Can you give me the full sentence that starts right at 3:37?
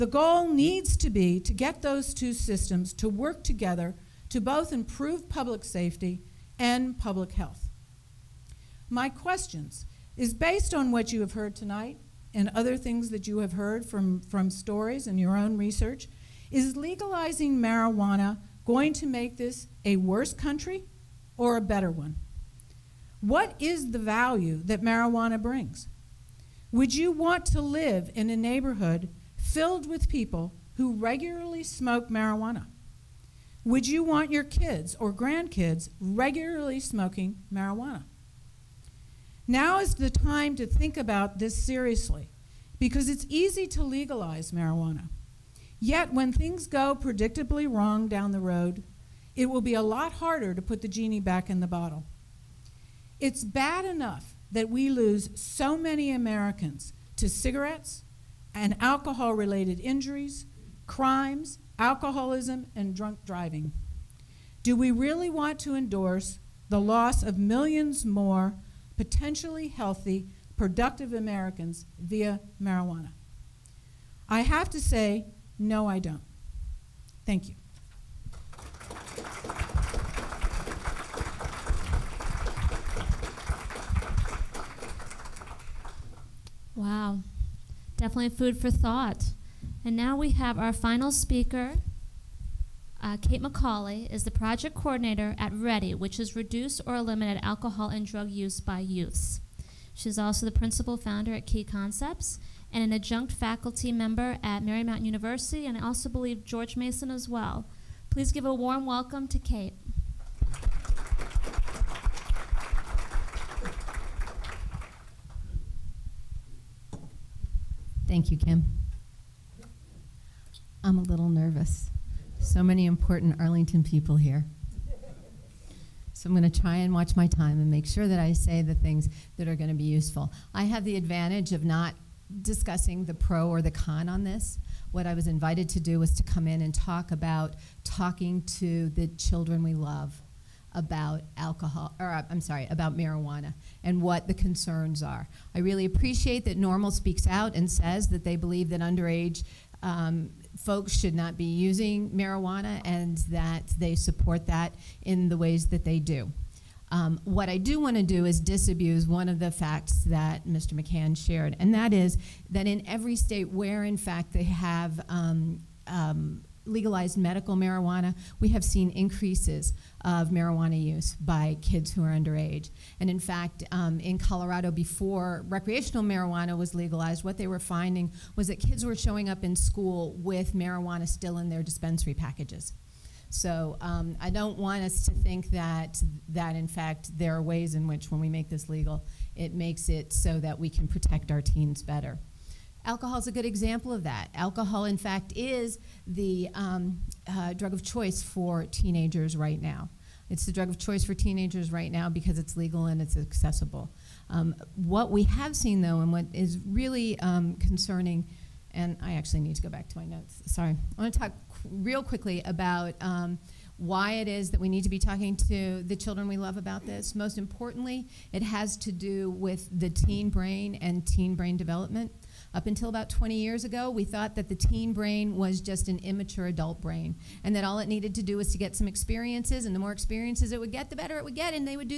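Most importantly, it has to do with the teen brain and teen brain development.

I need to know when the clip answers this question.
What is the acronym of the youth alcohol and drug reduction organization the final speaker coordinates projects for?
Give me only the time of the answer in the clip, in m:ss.
1:35.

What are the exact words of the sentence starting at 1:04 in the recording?
Do we really want to endorse the loss of millions more potentially healthy, productive Americans via marijuana?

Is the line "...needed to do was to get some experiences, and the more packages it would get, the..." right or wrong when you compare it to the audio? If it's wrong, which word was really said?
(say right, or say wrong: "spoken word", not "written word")
wrong: "experiences", not "packages".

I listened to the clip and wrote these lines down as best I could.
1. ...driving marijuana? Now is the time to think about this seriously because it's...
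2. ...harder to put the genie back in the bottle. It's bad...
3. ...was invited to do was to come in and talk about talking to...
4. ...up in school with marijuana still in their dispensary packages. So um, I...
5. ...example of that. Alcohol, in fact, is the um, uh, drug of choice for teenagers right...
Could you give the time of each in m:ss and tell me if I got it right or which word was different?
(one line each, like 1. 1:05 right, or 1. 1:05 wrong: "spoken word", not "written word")
1. 0:36 wrong: "smoking", not "driving"
2. 0:50 right
3. 2:15 right
4. 2:59 right
5. 3:13 right.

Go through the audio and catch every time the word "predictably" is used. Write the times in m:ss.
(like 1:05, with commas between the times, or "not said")
0:46.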